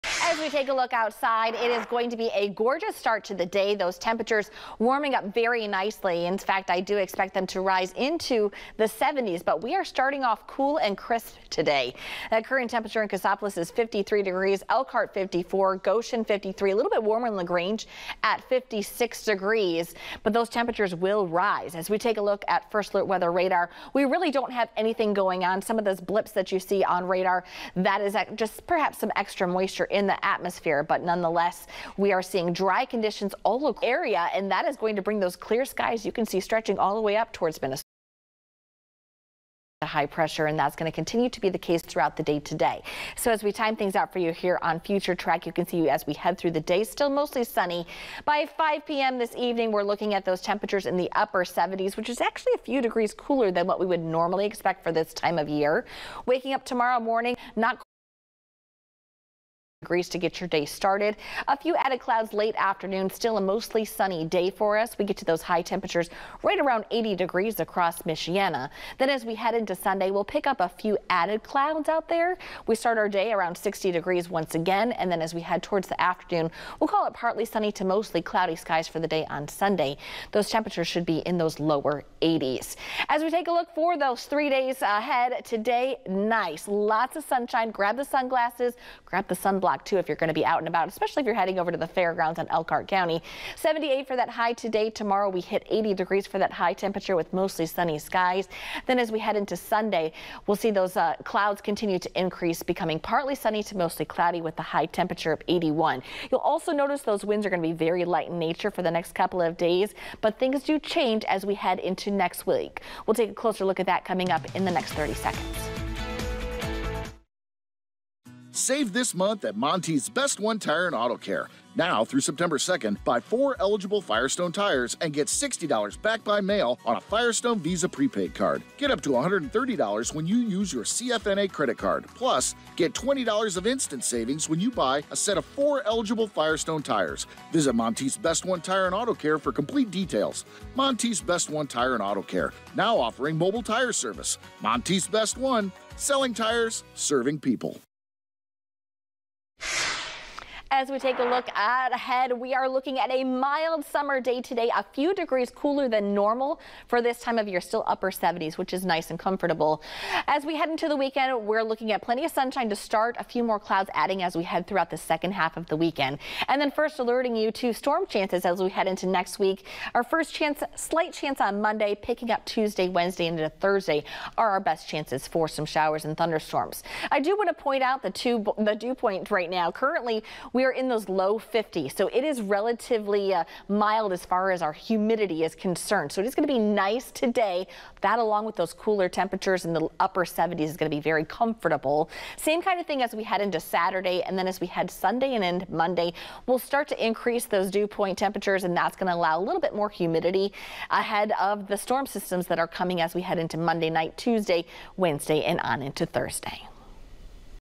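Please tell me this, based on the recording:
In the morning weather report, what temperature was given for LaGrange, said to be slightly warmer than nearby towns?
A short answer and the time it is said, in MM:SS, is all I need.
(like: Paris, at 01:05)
56 degrees, at 00:18.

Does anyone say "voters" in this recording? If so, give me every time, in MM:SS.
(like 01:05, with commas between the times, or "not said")
not said.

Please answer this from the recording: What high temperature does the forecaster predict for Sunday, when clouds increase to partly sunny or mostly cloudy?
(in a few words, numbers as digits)
81.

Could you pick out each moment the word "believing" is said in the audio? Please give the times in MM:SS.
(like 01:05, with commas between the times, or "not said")
not said.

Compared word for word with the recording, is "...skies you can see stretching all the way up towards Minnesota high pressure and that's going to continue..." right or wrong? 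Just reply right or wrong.
right.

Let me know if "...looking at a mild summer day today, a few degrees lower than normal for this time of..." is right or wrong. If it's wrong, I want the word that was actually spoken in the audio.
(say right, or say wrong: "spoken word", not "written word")
wrong: "cooler", not "lower".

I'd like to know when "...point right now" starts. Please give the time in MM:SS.
02:58.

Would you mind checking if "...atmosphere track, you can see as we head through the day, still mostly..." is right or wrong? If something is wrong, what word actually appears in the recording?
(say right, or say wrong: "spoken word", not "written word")
wrong: "future", not "atmosphere".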